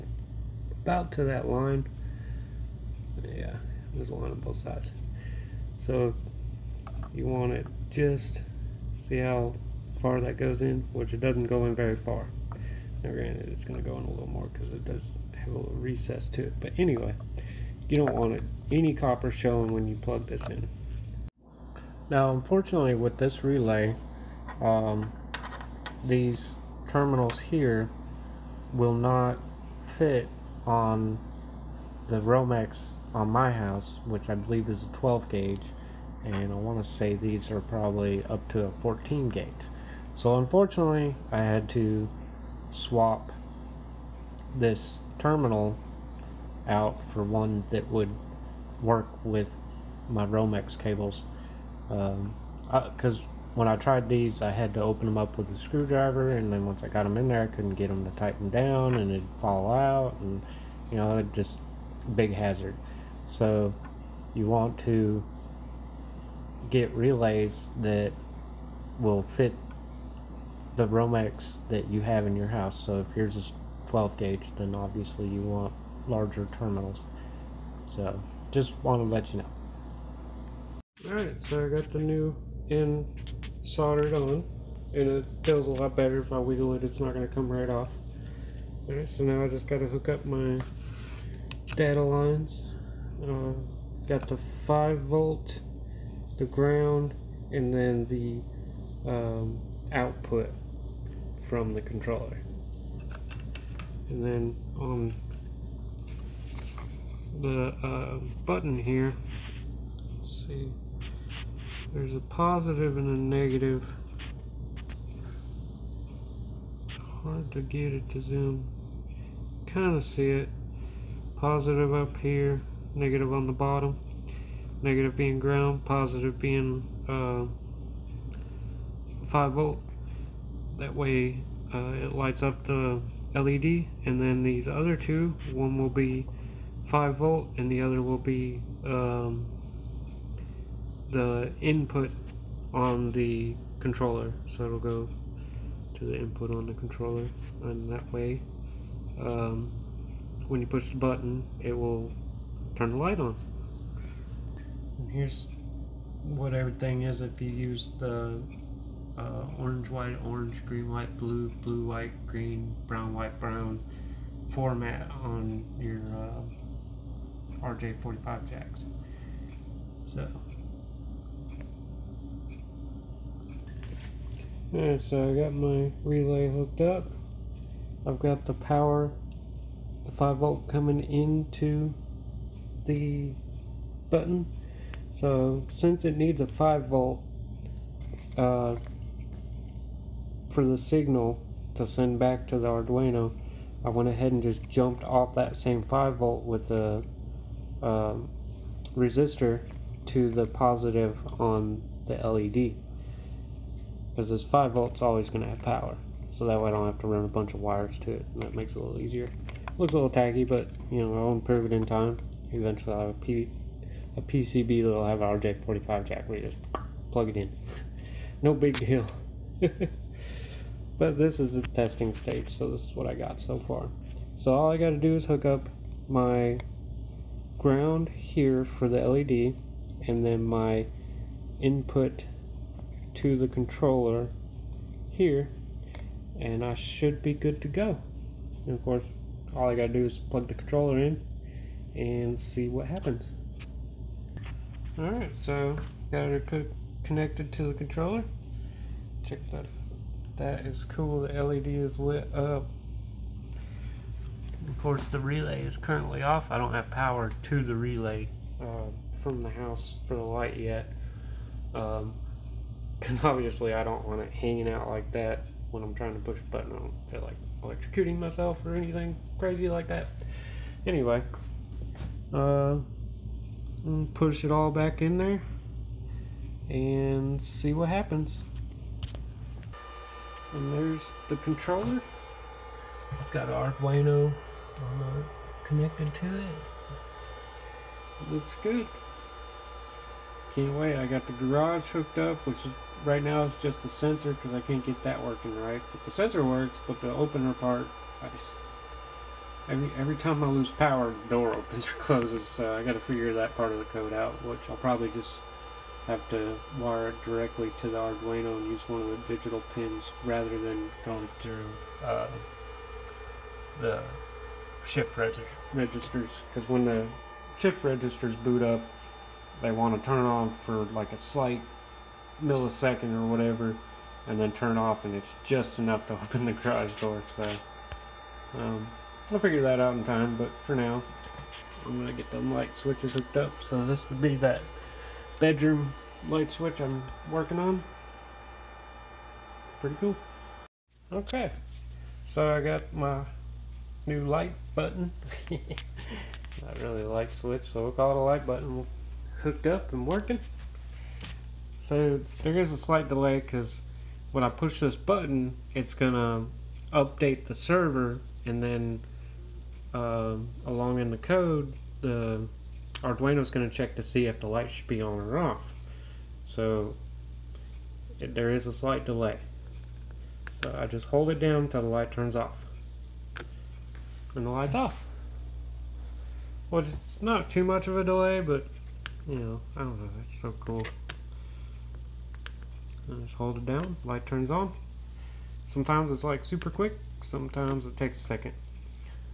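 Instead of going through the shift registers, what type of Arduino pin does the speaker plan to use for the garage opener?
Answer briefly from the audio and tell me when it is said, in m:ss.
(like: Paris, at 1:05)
digital pins, at 5:09.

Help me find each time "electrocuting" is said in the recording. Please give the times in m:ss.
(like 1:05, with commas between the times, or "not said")
4:27.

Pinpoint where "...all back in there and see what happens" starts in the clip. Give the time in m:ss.
4:34.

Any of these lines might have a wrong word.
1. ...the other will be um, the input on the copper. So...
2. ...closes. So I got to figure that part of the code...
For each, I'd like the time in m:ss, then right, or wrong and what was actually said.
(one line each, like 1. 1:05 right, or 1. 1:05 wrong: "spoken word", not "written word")
1. 2:17 wrong: "controller", not "copper"
2. 5:01 right.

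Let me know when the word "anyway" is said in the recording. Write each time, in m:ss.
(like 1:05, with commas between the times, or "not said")
0:16, 4:30.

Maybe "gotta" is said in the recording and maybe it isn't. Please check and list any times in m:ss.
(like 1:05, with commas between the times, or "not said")
3:44, 3:59.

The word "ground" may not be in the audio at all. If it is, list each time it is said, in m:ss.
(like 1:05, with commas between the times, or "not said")
1:36, 2:05, 3:47.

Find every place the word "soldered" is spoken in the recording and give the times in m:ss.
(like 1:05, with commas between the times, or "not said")
1:23.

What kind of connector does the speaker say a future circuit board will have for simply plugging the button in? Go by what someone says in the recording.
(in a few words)
RJ45 jack.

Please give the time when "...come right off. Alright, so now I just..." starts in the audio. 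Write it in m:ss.
1:27.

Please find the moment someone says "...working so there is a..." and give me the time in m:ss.
5:50.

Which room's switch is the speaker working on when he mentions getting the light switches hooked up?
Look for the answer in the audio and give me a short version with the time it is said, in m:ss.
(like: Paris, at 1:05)
bedroom, at 5:35.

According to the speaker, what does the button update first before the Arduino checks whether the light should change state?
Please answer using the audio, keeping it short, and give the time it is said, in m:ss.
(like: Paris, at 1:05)
the server, at 5:57.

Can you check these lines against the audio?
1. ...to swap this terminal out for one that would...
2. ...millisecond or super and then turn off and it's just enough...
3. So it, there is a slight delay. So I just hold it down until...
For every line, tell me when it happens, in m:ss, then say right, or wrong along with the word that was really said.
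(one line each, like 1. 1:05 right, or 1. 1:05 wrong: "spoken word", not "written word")
1. 0:41 right
2. 5:22 wrong: "whatever", not "super"
3. 6:06 right.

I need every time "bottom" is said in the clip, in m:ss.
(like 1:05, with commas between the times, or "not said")
2:03.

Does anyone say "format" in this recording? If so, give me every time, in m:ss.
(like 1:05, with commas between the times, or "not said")
2:44.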